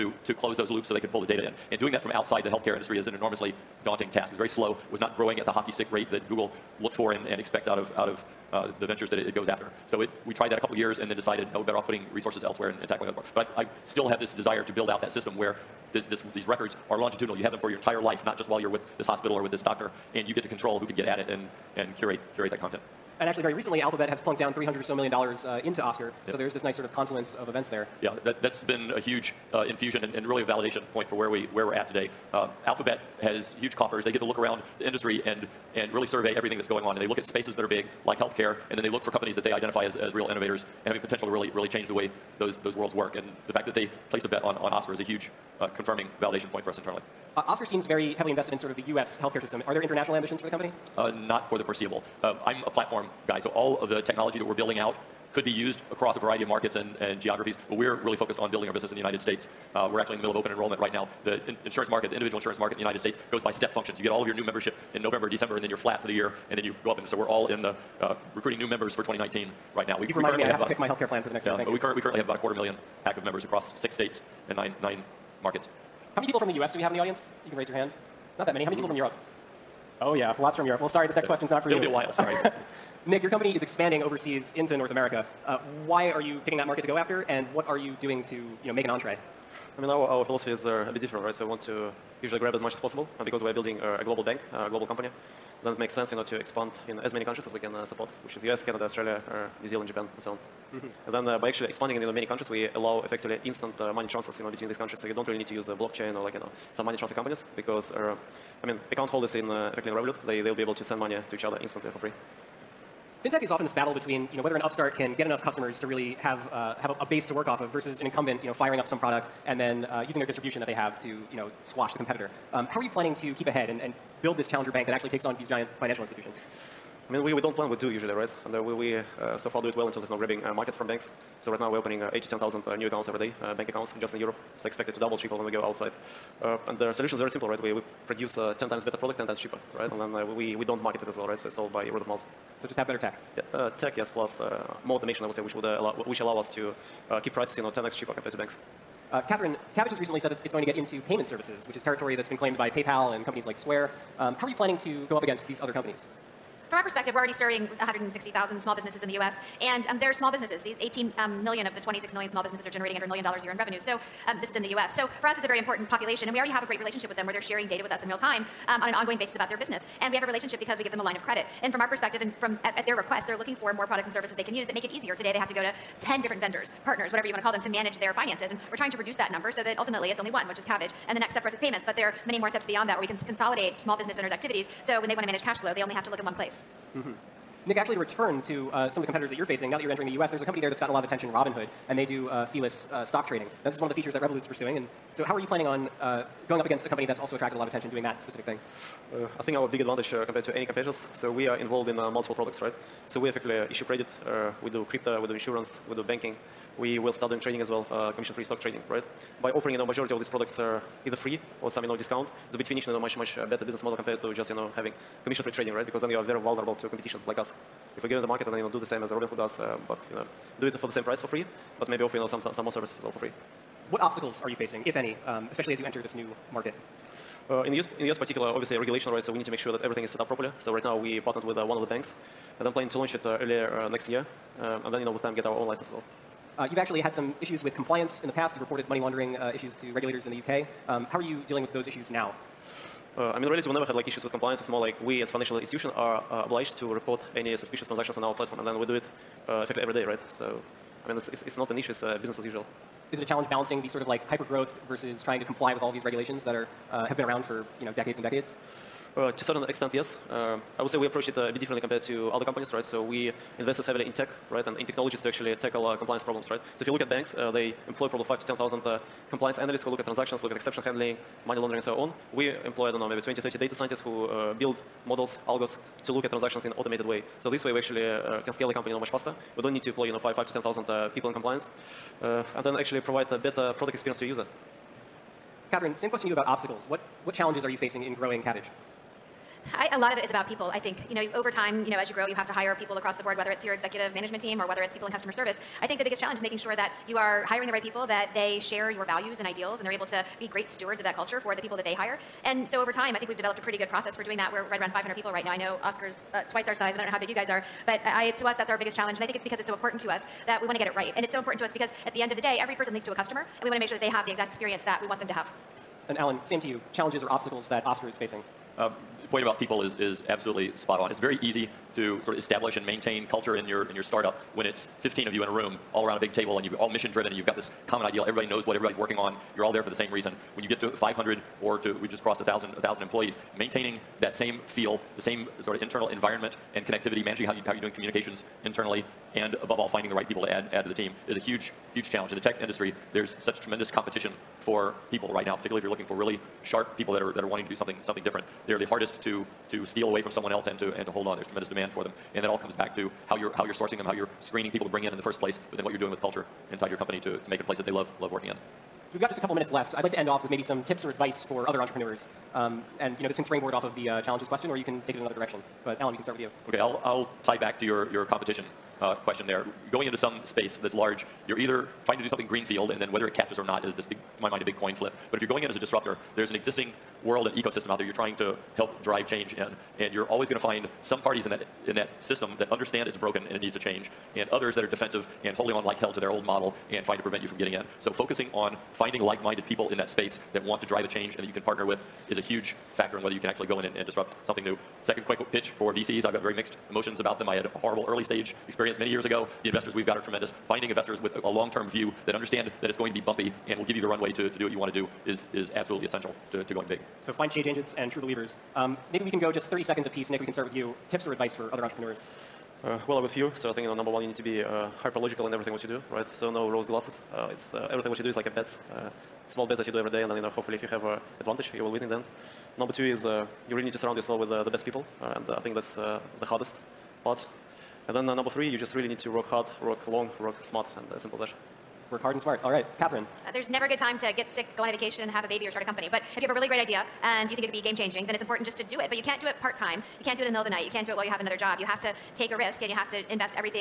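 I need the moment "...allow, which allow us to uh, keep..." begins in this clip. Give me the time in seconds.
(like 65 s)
145 s.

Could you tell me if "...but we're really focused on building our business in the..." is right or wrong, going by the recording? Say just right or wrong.
right.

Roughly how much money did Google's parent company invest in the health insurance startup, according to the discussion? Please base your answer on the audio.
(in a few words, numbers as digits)
300 million dollars.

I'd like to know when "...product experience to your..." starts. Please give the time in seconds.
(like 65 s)
283 s.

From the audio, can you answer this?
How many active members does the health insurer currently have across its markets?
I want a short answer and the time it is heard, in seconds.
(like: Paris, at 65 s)
a quarter million, at 72 s.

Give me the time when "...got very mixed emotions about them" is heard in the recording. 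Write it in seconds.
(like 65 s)
396 s.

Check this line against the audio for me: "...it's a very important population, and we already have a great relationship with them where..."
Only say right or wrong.
right.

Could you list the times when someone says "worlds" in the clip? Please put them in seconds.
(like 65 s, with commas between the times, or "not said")
42 s, 377 s.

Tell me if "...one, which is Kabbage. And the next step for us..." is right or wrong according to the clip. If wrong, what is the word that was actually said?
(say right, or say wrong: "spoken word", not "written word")
right.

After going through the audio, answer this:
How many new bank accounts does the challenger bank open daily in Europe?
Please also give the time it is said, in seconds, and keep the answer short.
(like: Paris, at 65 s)
8 to 10,000, at 132 s.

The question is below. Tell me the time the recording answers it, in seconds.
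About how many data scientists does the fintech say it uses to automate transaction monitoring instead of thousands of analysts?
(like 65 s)
273 s.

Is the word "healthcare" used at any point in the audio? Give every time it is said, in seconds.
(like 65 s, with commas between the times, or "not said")
2 s, 38 s, 49 s, 70 s.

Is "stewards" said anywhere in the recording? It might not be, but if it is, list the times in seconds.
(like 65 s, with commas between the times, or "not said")
300 s.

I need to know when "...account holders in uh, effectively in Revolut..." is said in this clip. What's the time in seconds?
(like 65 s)
108 s.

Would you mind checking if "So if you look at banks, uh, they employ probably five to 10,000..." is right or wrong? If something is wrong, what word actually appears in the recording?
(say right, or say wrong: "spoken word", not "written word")
right.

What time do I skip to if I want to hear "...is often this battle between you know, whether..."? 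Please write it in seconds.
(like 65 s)
113 s.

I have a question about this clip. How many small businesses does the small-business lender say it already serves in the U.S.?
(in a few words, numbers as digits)
160,000.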